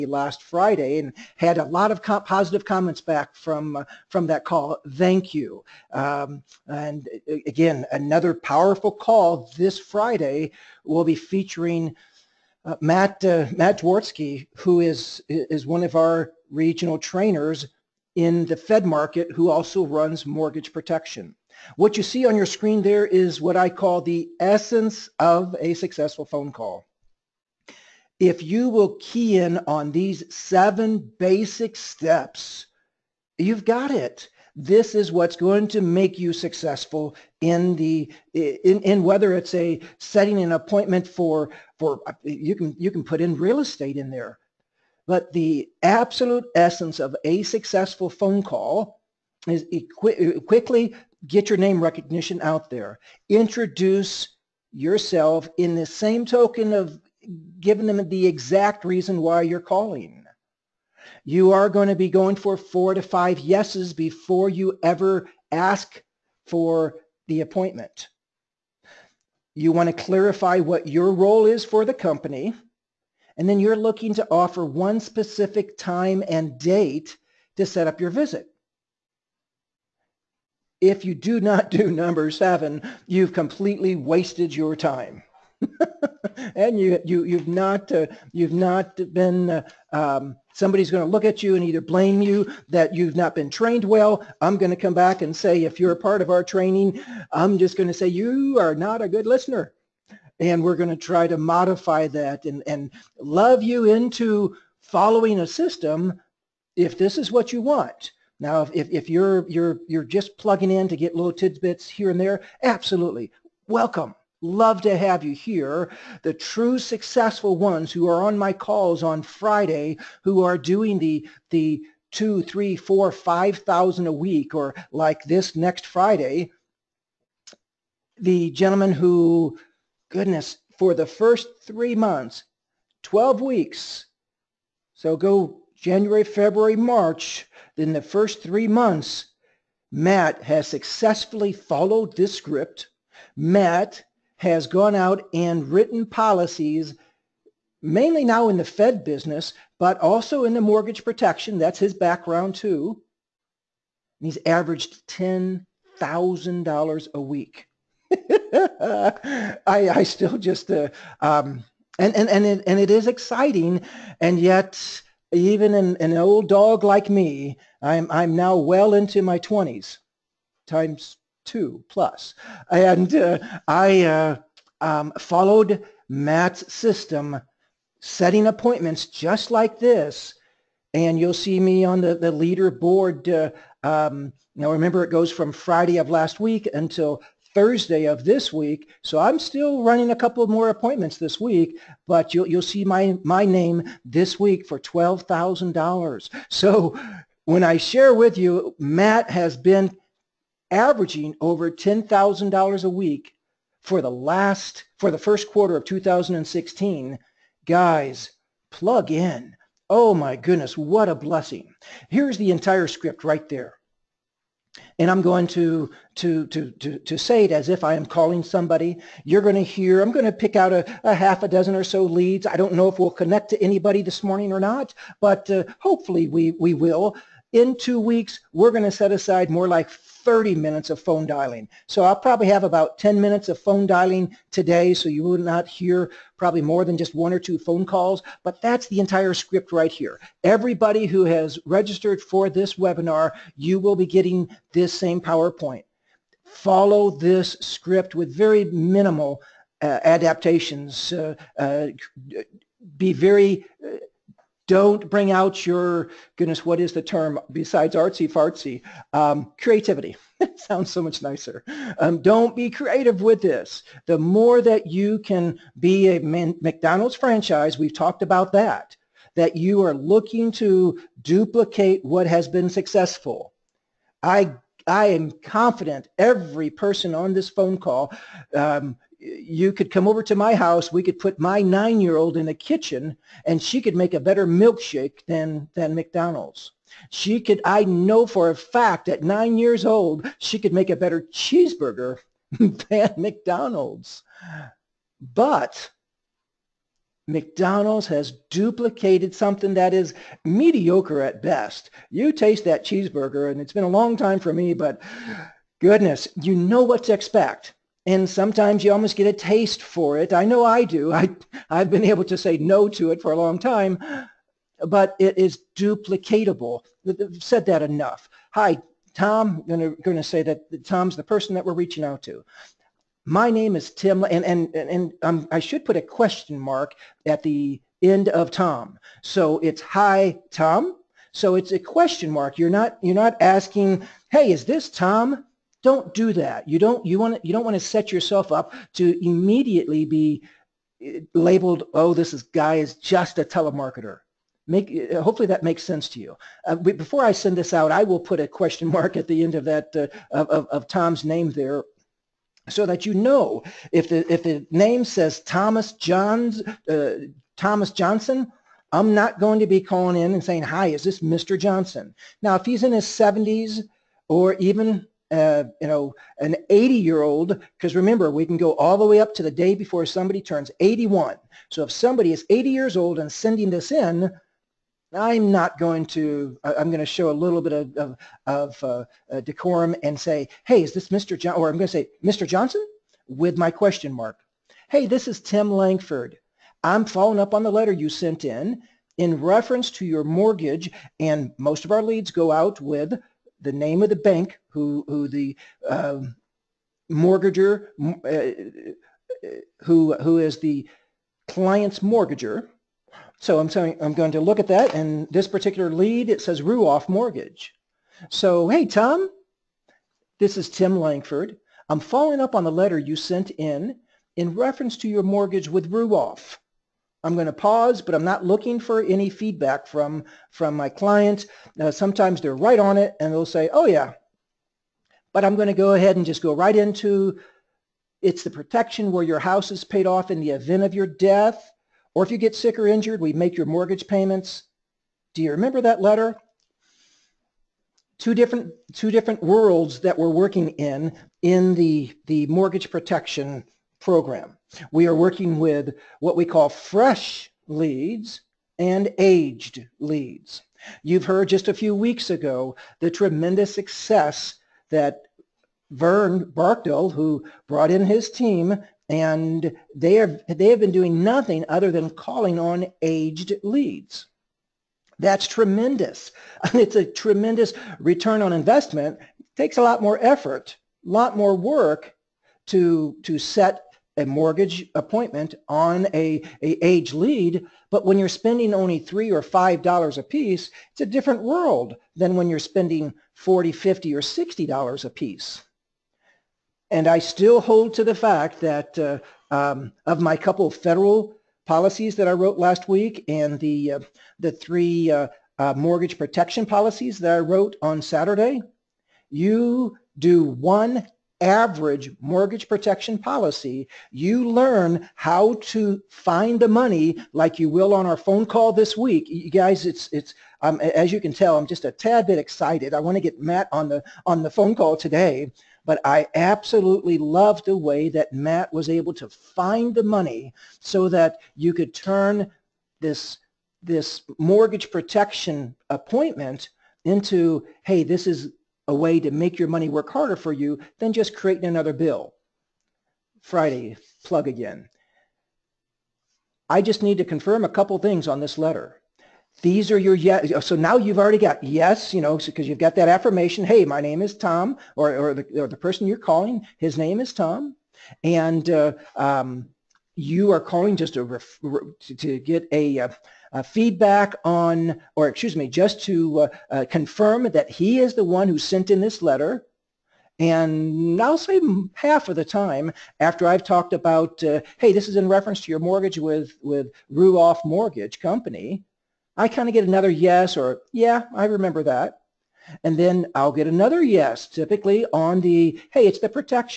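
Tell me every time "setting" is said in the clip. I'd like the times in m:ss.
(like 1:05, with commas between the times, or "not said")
0:39, 2:58.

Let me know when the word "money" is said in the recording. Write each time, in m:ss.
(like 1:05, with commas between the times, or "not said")
8:26, 8:40, 8:49.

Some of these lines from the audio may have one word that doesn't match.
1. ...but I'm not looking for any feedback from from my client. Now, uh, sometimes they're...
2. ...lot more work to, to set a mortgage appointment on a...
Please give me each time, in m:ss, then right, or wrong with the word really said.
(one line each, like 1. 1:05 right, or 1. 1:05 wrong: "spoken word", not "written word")
1. 6:58 right
2. 7:51 right.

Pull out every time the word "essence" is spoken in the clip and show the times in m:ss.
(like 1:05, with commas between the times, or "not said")
0:24, 0:46.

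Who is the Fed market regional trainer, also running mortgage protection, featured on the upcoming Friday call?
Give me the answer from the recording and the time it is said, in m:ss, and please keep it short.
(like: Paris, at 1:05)
Matt Dworsky, at 0:13.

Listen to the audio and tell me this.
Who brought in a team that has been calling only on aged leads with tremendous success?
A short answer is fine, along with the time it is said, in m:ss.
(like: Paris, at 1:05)
Vern Barkdale, at 7:35.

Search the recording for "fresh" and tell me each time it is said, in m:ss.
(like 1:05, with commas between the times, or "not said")
7:26.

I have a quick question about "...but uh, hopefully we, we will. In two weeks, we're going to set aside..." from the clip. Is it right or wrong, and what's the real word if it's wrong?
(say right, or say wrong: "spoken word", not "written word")
right.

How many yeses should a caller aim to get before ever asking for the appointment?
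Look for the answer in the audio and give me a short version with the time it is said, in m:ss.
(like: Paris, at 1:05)
4 to 5, at 1:02.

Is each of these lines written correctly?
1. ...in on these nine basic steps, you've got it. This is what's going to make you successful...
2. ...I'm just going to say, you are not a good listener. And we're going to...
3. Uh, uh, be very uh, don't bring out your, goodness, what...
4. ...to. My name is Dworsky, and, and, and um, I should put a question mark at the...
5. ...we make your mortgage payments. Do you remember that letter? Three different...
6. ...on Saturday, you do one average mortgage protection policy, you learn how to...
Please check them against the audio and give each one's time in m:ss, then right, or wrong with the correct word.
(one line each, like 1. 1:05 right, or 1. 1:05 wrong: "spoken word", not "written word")
1. 0:29 wrong: "seven", not "nine"
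2. 1:37 right
3. 4:11 right
4. 5:22 wrong: "Tim", not "Dworsky"
5. 7:13 wrong: "Two", not "Three"
6. 8:17 right.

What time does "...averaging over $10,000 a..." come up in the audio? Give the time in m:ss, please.
3:20.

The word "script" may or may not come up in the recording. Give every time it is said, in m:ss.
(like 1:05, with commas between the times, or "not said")
2:22, 3:32, 3:59, 4:07.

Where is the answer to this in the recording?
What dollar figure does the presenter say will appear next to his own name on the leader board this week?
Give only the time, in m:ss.
3:14.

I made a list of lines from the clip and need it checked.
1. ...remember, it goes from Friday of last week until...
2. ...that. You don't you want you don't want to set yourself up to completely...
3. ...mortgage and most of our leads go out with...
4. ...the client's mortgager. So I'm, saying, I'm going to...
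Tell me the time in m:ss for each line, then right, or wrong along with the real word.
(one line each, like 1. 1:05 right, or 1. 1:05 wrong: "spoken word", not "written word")
1. 3:04 right
2. 5:36 wrong: "immediately", not "completely"
3. 6:30 right
4. 6:40 right.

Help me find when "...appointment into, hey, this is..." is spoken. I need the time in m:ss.
8:45.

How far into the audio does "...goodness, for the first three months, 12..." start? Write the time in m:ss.
2:10.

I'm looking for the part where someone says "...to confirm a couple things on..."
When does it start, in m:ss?
8:57.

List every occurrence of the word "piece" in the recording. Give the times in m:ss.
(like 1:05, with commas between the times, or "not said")
8:00, 8:05.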